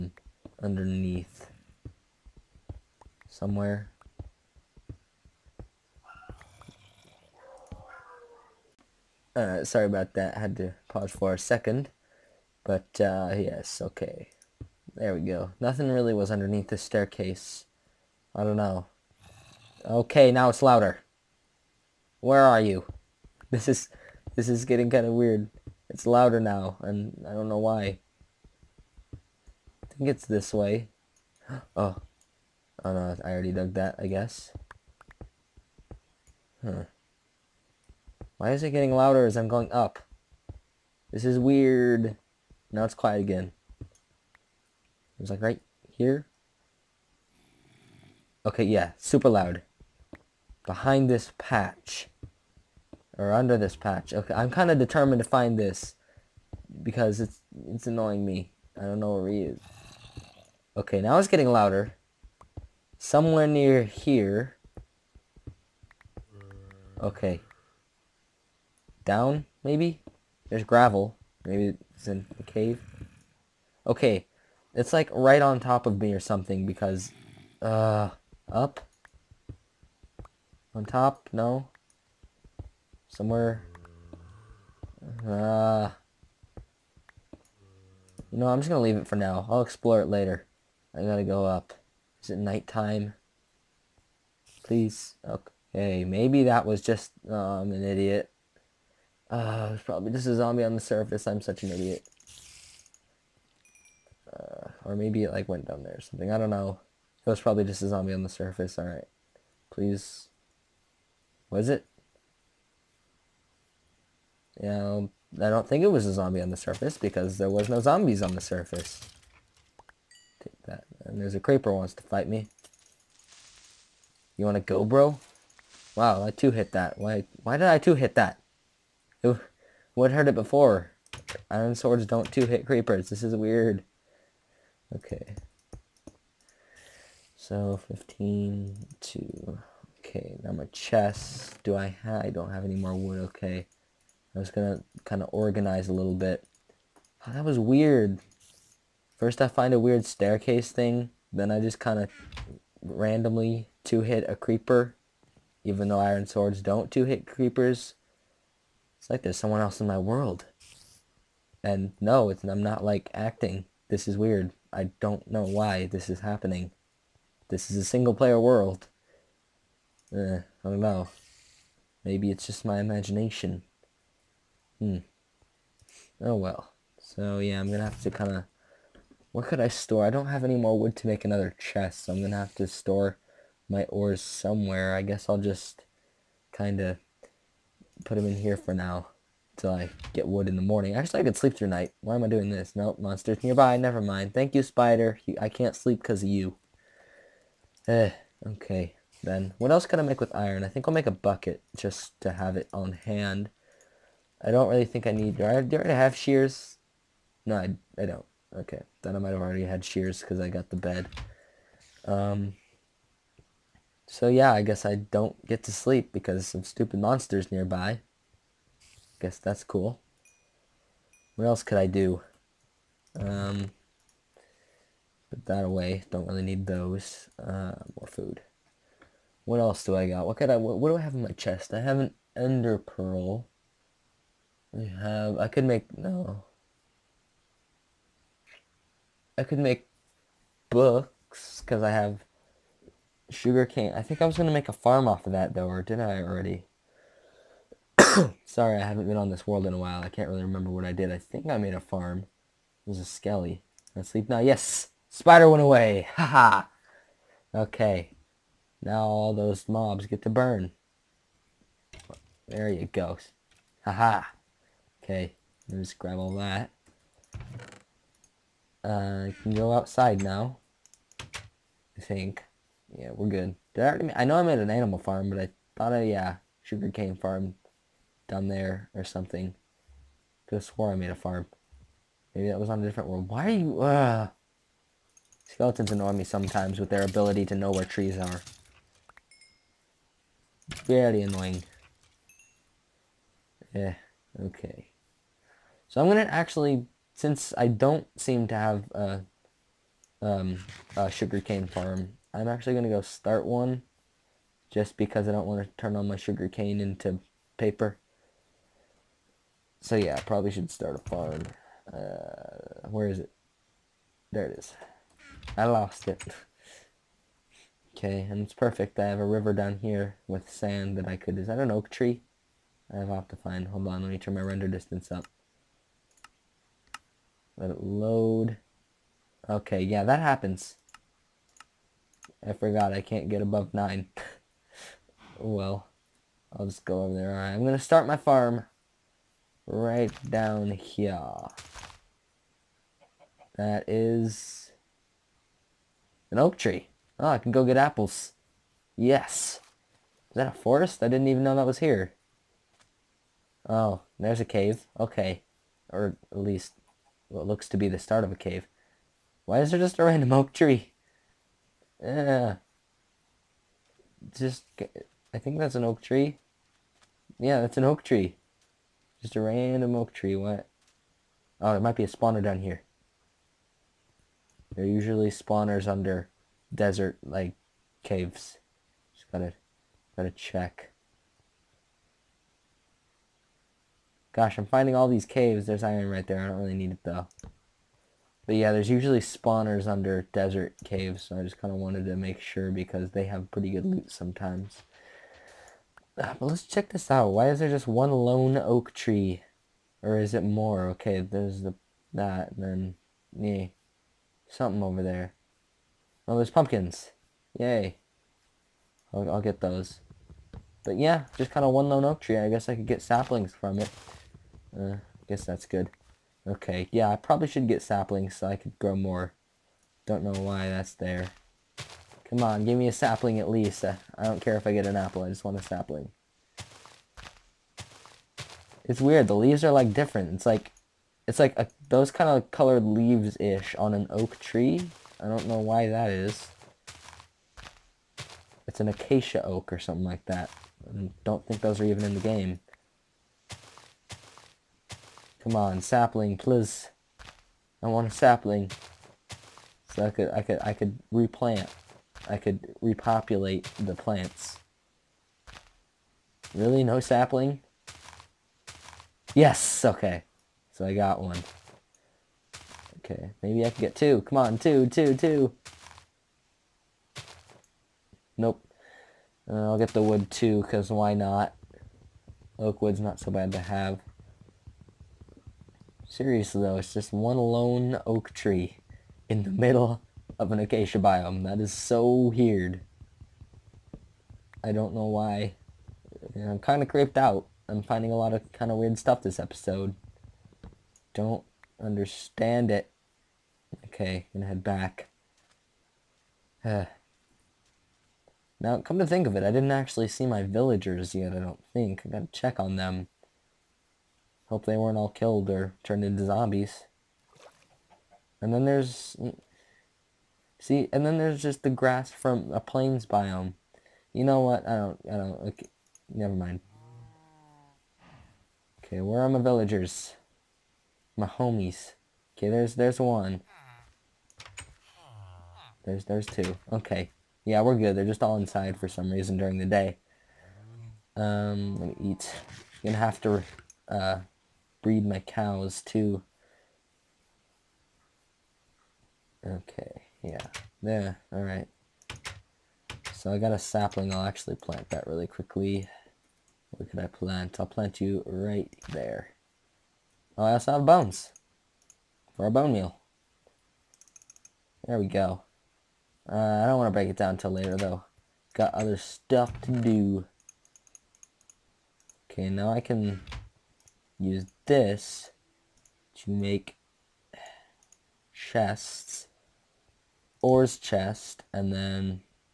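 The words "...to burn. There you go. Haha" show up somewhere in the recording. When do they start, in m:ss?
4:20.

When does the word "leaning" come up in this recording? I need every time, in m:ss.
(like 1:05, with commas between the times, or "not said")
not said.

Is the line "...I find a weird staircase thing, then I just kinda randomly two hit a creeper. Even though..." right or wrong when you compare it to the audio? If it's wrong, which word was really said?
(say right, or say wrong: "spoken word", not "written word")
right.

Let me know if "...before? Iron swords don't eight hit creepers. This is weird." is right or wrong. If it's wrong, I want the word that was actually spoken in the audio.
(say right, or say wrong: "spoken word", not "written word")
wrong: "two", not "eight".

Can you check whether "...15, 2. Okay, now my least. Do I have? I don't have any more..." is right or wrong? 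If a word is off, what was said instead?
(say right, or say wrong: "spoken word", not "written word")
wrong: "chest", not "least".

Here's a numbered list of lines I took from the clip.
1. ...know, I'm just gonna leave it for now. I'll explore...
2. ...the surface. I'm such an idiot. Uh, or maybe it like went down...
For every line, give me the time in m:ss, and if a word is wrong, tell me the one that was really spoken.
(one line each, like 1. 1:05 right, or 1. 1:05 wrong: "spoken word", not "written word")
1. 1:28 right
2. 1:40 right.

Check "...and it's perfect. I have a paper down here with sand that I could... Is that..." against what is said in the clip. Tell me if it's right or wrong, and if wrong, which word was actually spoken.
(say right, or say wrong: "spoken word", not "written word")
wrong: "river", not "paper".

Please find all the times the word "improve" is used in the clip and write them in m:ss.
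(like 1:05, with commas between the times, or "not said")
not said.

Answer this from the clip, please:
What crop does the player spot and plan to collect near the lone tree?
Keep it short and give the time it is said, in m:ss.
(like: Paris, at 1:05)
Pumpkins, at 6:46.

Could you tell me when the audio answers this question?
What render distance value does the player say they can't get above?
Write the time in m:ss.
5:33.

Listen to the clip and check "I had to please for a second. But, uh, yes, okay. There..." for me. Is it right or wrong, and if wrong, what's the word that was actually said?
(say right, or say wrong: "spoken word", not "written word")
wrong: "pause", not "please".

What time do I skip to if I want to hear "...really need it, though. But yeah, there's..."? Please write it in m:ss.
6:26.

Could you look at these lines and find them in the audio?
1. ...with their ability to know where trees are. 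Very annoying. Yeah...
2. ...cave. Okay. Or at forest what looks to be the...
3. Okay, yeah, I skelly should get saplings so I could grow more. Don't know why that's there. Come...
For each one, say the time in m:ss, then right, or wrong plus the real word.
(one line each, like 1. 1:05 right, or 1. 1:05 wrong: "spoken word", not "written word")
1. 4:46 right
2. 5:54 wrong: "least", not "forest"
3. 6:56 wrong: "probably", not "skelly".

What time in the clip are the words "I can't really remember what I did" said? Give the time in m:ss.
4:10.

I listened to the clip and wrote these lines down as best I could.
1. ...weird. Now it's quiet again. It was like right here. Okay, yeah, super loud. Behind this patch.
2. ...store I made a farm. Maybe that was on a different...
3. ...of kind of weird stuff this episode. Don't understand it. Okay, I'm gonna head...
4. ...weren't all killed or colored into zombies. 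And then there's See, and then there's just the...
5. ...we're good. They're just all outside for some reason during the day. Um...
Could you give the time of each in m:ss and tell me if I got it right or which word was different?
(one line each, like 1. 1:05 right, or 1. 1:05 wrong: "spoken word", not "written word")
1. 0:41 right
2. 4:40 wrong: "swore", not "store"
3. 8:08 right
4. 8:24 wrong: "turned", not "colored"
5. 8:47 wrong: "inside", not "outside".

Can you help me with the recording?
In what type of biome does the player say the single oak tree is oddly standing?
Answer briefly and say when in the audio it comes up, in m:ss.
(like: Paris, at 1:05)
Acacia biome, at 8:00.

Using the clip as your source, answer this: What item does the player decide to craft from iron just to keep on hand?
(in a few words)
A bucket.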